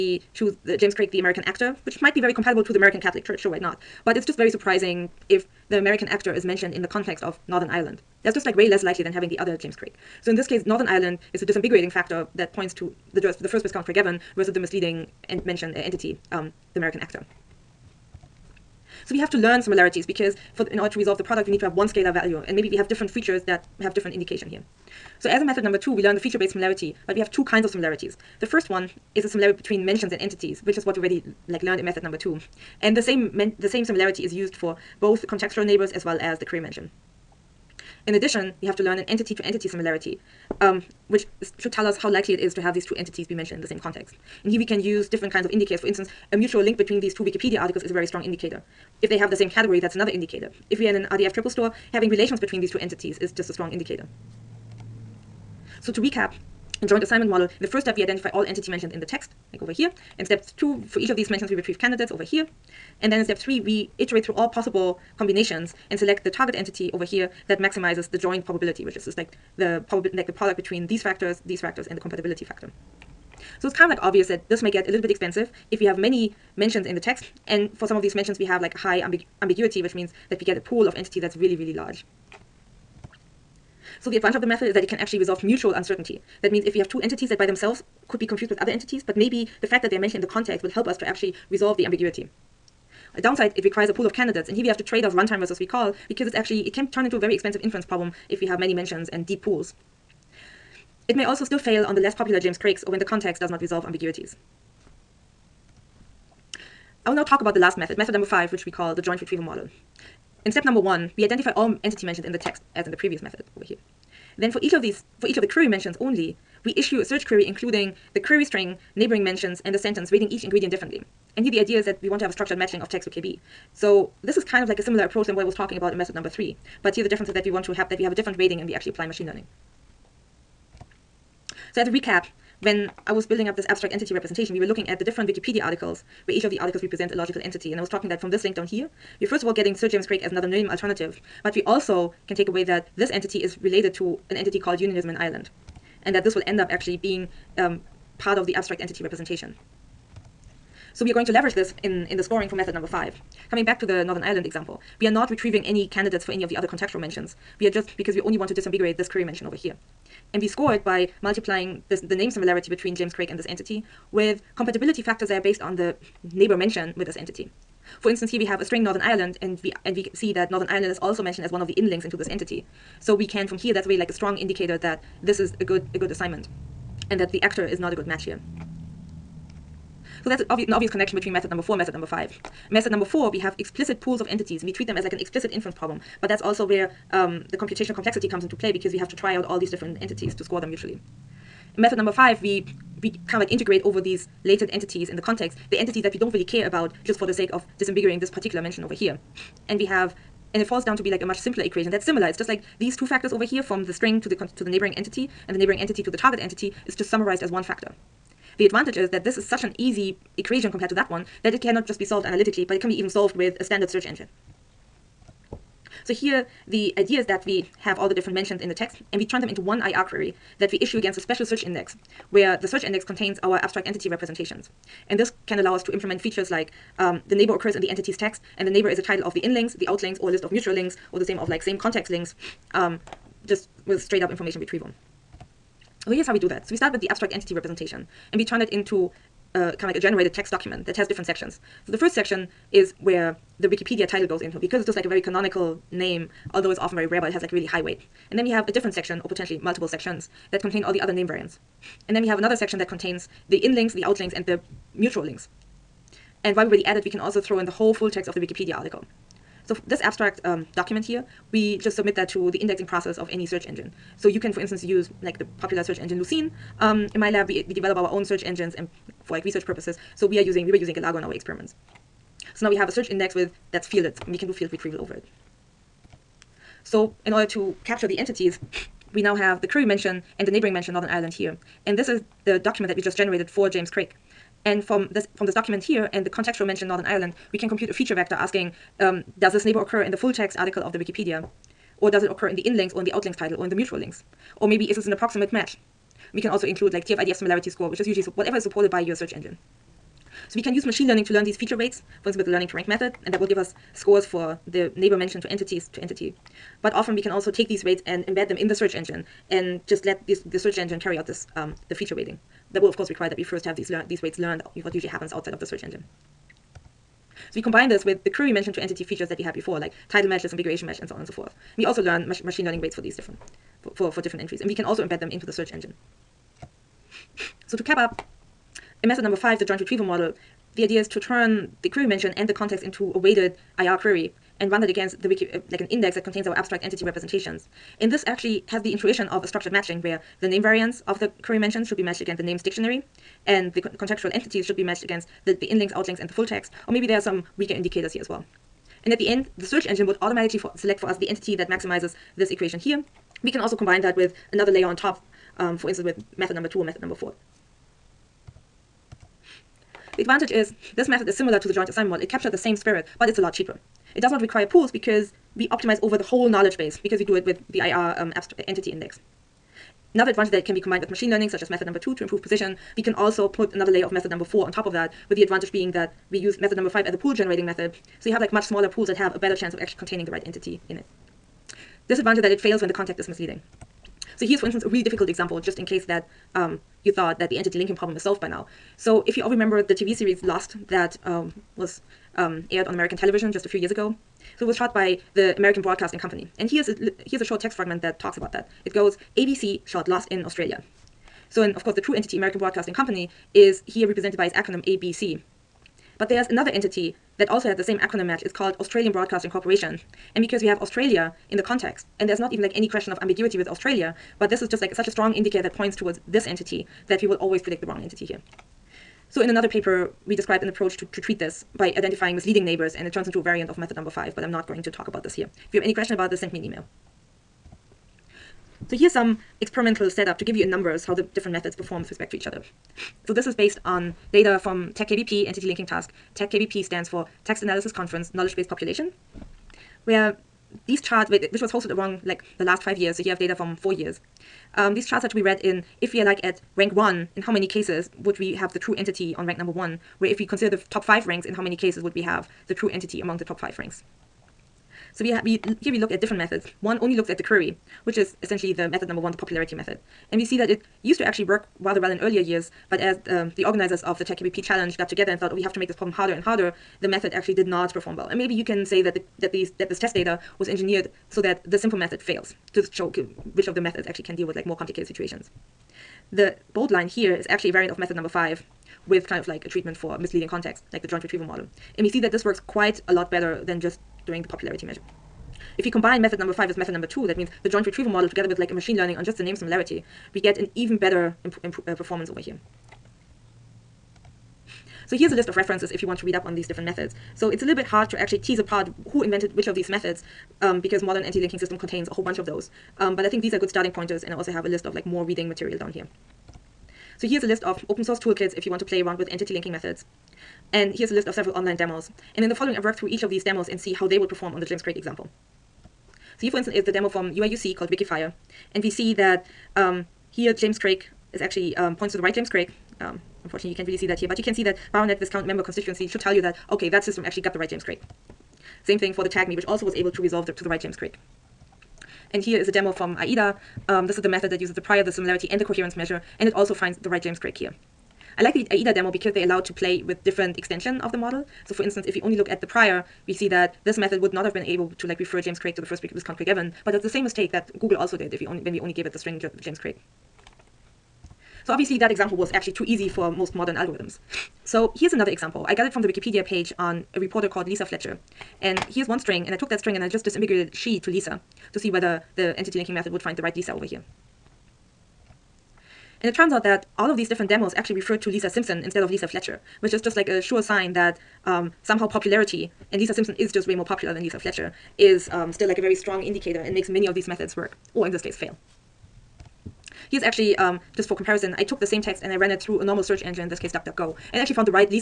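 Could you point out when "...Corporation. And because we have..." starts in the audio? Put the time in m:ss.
6:49.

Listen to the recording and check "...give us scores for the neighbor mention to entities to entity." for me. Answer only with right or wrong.
right.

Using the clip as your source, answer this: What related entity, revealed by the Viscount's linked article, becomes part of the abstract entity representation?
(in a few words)
Unionism in Ireland.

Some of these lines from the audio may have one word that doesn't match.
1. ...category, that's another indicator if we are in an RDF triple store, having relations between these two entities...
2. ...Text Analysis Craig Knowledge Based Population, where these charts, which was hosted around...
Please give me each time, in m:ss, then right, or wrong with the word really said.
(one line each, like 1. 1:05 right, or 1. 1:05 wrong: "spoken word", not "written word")
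1. 0:49 right
2. 7:17 wrong: "Conference", not "Craig".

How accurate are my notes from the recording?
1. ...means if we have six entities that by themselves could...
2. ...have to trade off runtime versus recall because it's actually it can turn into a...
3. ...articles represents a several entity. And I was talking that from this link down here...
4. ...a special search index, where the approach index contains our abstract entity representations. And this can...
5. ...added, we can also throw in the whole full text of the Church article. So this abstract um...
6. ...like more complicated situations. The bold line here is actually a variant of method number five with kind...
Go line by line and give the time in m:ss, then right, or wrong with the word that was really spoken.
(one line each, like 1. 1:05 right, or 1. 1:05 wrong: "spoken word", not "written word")
1. 1:26 wrong: "two", not "six"
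2. 1:34 right
3. 2:16 wrong: "logical", not "several"
4. 3:41 wrong: "search", not "approach"
5. 4:16 wrong: "Wikipedia", not "Church"
6. 7:54 right.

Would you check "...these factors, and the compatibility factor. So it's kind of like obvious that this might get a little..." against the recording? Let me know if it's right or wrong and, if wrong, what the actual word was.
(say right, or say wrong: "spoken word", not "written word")
right.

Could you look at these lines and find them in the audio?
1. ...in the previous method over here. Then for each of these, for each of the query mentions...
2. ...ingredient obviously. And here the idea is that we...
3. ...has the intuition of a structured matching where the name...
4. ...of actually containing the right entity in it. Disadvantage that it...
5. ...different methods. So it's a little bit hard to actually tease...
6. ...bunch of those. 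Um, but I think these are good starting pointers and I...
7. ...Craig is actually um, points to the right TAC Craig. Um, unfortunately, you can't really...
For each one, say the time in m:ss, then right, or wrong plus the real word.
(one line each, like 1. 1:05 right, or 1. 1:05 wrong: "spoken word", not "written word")
1. 1:52 right
2. 2:00 wrong: "differently", not "obviously"
3. 5:38 right
4. 6:19 right
5. 8:16 right
6. 8:22 right
7. 8:40 wrong: "James", not "TAC".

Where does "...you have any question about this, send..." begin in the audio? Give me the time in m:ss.
7:05.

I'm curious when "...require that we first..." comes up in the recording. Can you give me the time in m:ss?
5:13.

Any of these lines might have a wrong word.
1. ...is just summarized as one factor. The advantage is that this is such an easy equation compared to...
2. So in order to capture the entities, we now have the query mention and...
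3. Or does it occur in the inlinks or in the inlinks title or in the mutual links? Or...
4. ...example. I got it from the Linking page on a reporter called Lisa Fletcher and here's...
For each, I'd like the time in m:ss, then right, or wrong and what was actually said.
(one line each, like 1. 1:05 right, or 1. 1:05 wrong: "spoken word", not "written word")
1. 3:26 right
2. 4:36 right
3. 4:51 wrong: "outlinks", not "inlinks"
4. 9:15 wrong: "Wikipedia", not "Linking".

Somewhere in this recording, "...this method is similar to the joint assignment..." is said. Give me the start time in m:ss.
6:00.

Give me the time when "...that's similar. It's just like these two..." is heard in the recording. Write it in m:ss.
3:21.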